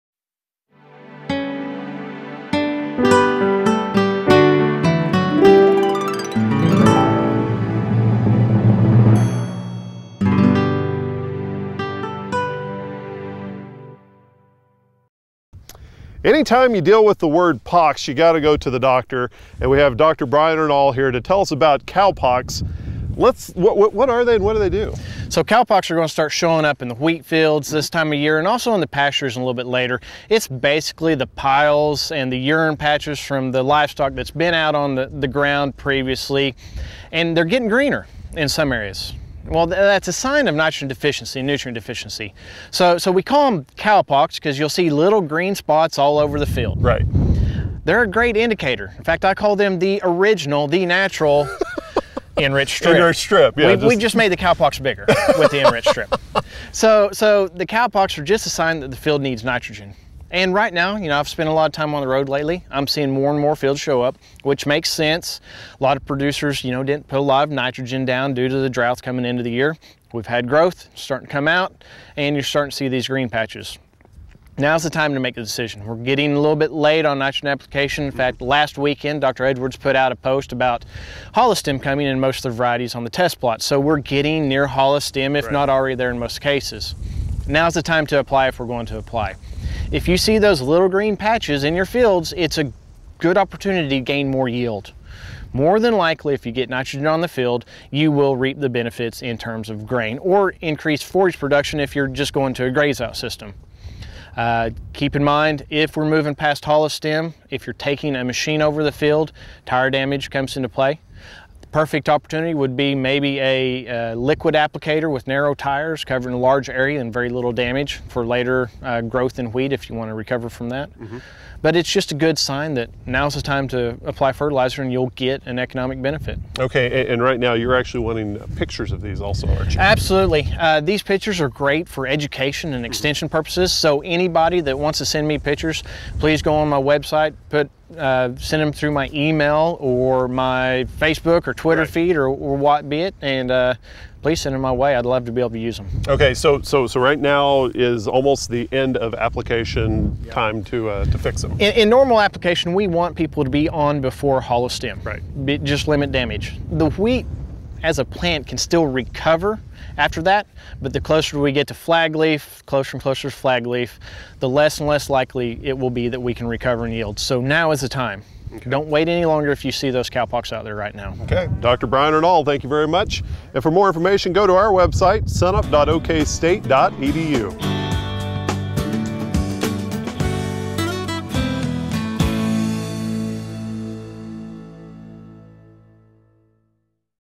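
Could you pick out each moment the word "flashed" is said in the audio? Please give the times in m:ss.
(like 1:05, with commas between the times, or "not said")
not said.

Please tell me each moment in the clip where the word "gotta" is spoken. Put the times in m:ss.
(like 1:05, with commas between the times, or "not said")
0:18.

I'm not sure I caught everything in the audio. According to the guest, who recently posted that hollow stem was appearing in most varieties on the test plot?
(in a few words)
Dr. Edwards.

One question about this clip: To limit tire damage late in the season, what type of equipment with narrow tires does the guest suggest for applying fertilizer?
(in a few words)
liquid applicator.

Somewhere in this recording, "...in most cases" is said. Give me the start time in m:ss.
1:26.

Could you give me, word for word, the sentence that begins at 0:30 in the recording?
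It's basically the piles and the urine patches from the livestock that's been out on the, the ground previously.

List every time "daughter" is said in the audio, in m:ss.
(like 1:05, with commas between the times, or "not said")
not said.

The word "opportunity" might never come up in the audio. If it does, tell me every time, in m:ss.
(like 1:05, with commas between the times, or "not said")
1:33, 1:52.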